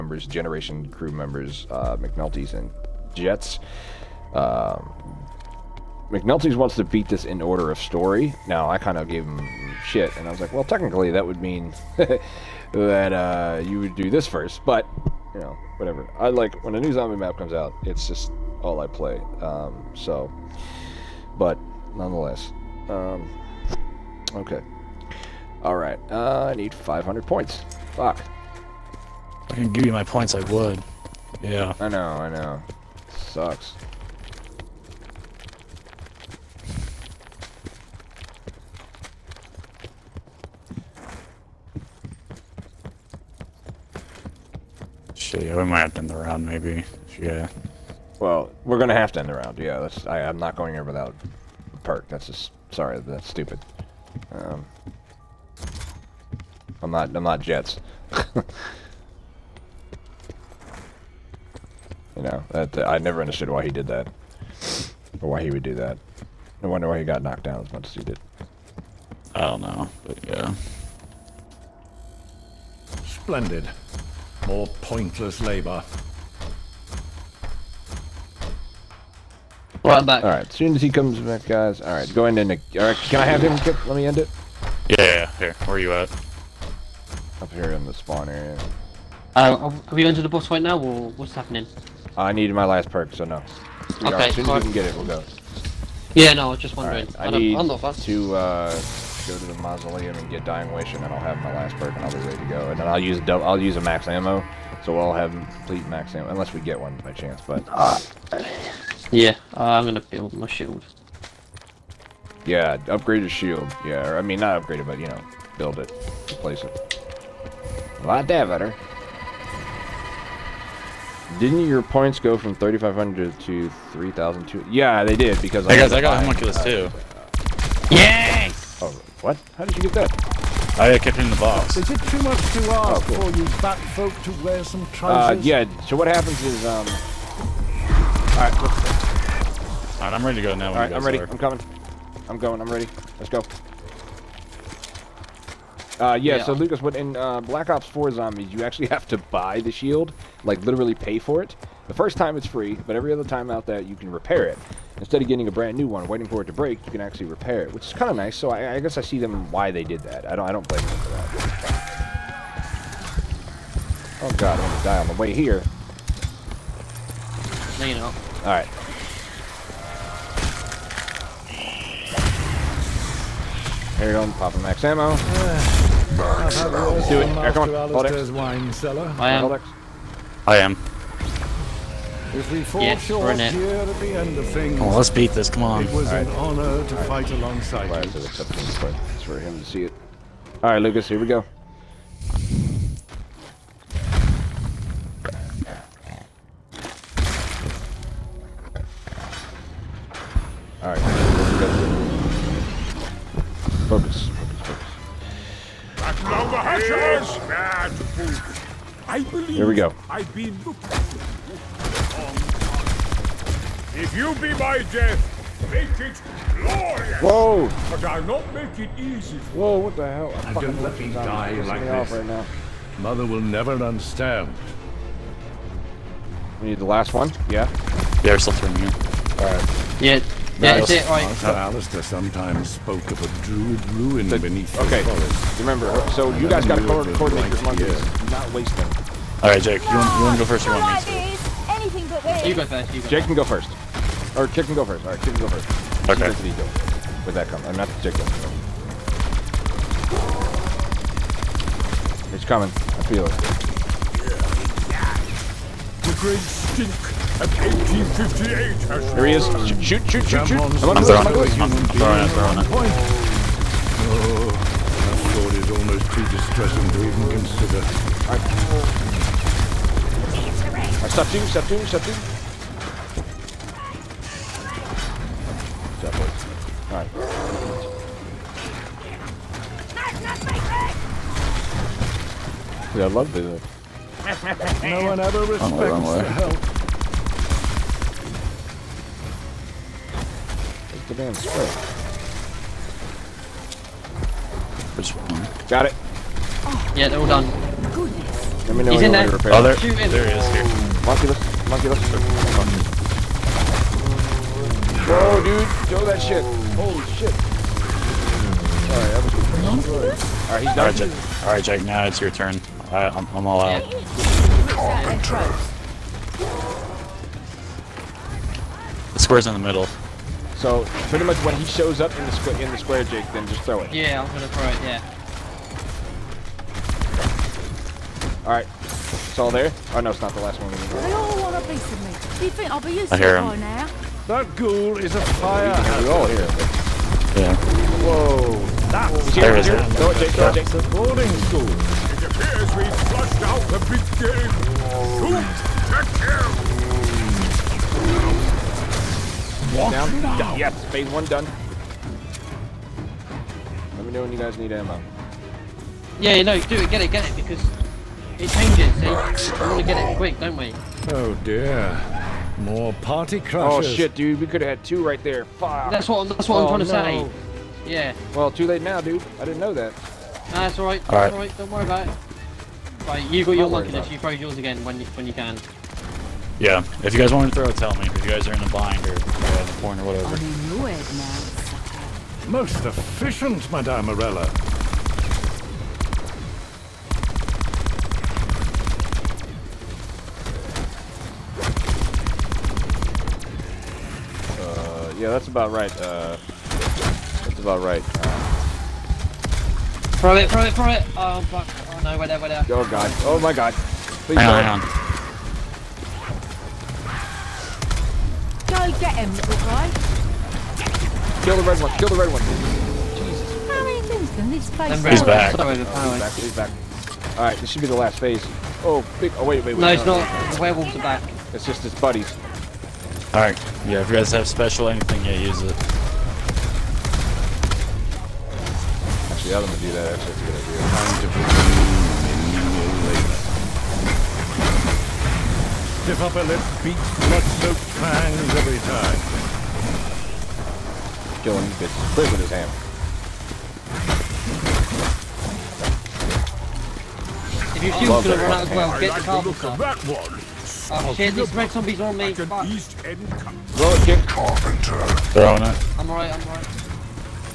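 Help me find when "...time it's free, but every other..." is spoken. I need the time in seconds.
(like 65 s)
152 s.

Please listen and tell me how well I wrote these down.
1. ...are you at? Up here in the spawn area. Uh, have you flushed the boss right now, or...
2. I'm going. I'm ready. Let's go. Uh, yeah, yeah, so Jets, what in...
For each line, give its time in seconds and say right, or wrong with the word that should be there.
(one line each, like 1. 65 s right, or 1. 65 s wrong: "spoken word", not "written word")
1. 85 s wrong: "entered", not "flushed"
2. 142 s wrong: "Lucas", not "Jets".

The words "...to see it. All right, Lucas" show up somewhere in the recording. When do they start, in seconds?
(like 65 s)
189 s.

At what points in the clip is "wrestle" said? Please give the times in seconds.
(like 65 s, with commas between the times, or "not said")
not said.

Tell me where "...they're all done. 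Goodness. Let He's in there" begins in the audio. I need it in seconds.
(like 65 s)
297 s.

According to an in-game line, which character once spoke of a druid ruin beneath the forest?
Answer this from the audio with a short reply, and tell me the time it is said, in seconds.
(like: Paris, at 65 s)
Alistair, at 231 s.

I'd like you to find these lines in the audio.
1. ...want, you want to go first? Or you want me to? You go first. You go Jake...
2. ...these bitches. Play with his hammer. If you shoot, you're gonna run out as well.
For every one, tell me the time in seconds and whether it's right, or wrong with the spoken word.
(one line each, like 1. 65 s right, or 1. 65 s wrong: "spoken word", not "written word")
1. 239 s right
2. 441 s right.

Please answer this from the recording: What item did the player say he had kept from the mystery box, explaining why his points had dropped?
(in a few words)
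Homunculus.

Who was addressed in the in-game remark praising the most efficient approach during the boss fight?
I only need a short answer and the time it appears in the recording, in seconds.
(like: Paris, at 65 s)
Madame Morella, at 383 s.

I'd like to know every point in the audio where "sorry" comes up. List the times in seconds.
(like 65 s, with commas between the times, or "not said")
52 s, 415 s.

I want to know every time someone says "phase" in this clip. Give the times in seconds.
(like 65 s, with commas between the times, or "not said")
350 s, 418 s.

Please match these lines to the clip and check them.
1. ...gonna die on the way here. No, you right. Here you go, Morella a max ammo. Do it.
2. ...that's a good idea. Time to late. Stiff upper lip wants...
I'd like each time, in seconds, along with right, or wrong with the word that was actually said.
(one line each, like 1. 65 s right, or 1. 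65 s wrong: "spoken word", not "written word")
1. 164 s wrong: "Pop", not "Morella"
2. 430 s wrong: "beats", not "wants".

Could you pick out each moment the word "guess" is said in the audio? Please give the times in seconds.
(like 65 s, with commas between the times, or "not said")
158 s.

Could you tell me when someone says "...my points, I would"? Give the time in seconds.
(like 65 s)
29 s.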